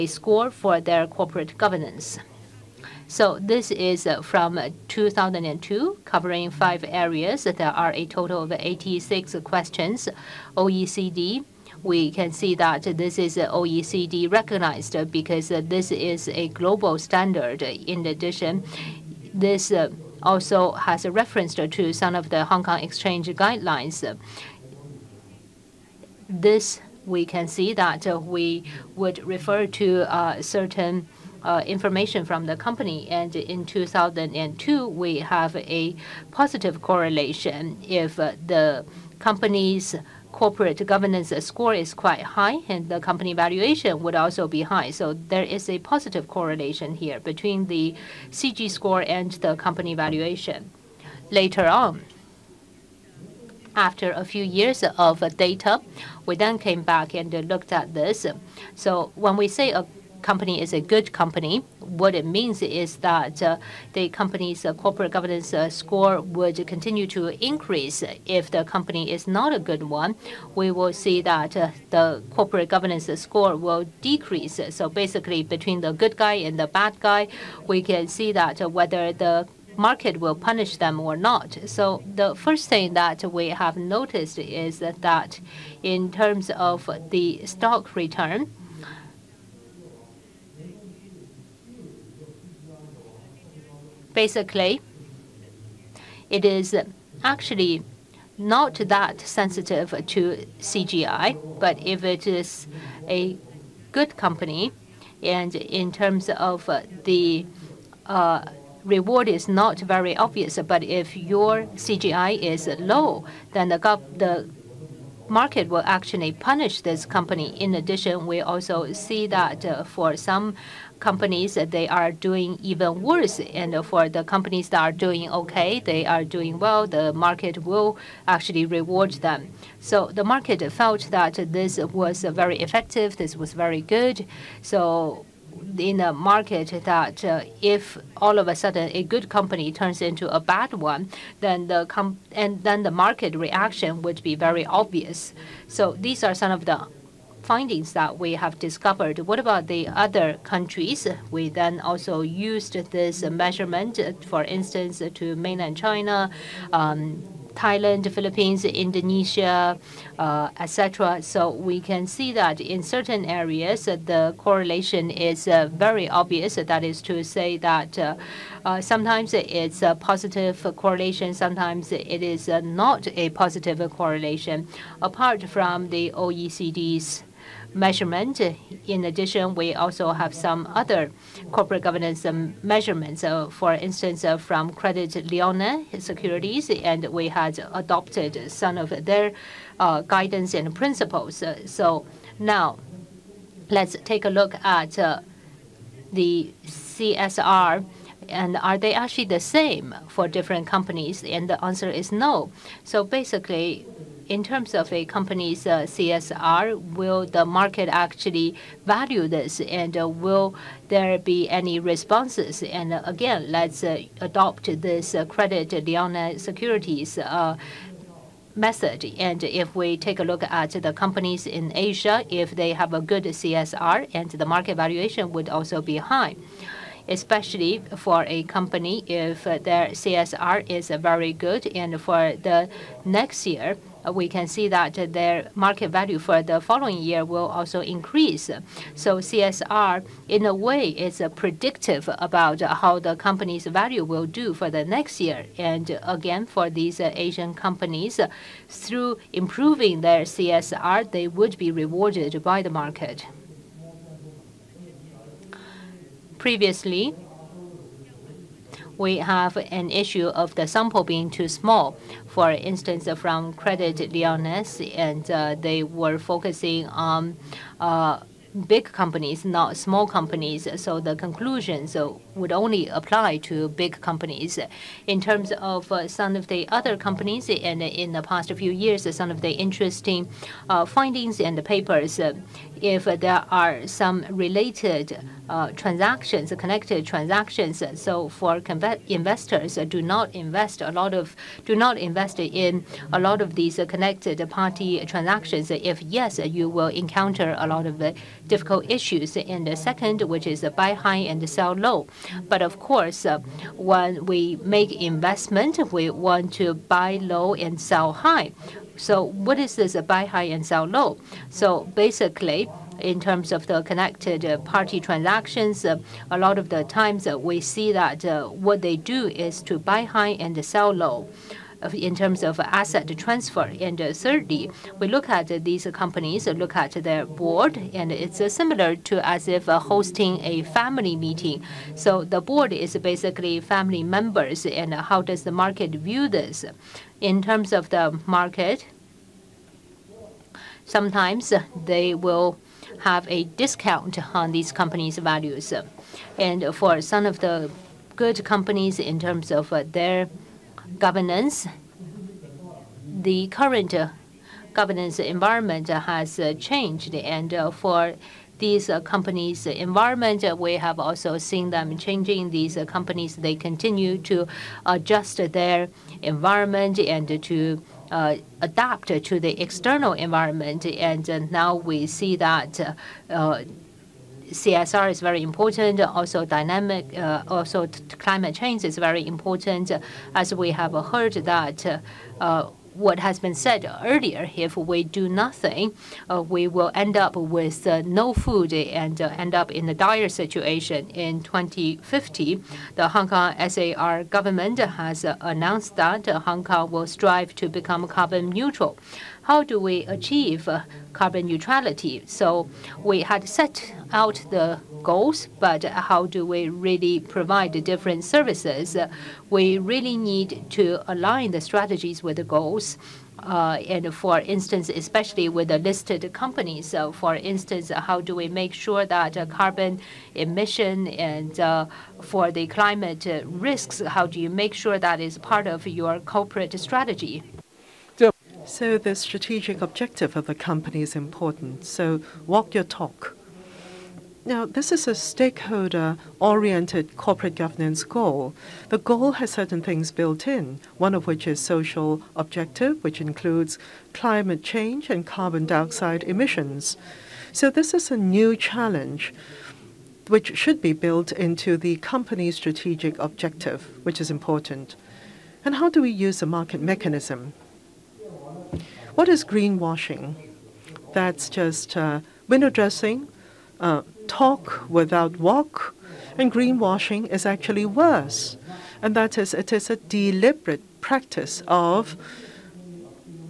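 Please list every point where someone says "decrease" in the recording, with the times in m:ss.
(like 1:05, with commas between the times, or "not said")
1:13.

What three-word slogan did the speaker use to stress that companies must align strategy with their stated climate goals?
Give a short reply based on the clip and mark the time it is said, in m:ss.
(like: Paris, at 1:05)
Walk your talk, at 7:12.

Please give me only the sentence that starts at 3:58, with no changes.
So CSR, in a way, is uh, predictive about how the company's value will do for the next year.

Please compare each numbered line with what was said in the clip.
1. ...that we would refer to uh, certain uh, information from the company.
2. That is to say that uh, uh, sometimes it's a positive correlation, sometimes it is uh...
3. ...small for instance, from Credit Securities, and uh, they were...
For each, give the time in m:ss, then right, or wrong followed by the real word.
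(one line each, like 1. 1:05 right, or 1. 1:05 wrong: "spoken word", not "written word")
1. 0:27 right
2. 2:46 right
3. 4:21 wrong: "Lyonnais", not "Securities".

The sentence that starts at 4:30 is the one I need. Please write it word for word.
So the conclusions would only apply to big companies.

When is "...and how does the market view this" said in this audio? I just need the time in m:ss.
5:34.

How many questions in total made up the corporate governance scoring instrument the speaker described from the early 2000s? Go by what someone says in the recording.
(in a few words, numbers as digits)
86.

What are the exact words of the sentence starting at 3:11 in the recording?
So now let's take a look at uh, the CSR and are they actually the same for different companies?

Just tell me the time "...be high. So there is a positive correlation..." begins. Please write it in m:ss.
0:44.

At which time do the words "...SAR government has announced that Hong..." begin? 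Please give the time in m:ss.
6:33.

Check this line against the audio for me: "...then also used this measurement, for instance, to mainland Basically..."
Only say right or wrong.
wrong.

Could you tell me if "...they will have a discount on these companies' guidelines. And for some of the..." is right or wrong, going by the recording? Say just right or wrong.
wrong.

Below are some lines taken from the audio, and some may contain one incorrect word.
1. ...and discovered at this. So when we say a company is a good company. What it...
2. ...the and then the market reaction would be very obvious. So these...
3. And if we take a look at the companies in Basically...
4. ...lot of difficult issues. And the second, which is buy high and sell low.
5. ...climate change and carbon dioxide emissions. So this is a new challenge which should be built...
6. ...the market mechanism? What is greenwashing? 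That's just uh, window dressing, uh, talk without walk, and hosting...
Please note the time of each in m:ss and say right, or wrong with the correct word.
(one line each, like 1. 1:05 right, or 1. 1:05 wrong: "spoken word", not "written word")
1. 0:57 wrong: "looked", not "discovered"
2. 2:21 right
3. 3:39 wrong: "Asia", not "Basically"
4. 4:57 right
5. 7:24 right
6. 7:36 wrong: "greenwashing", not "hosting".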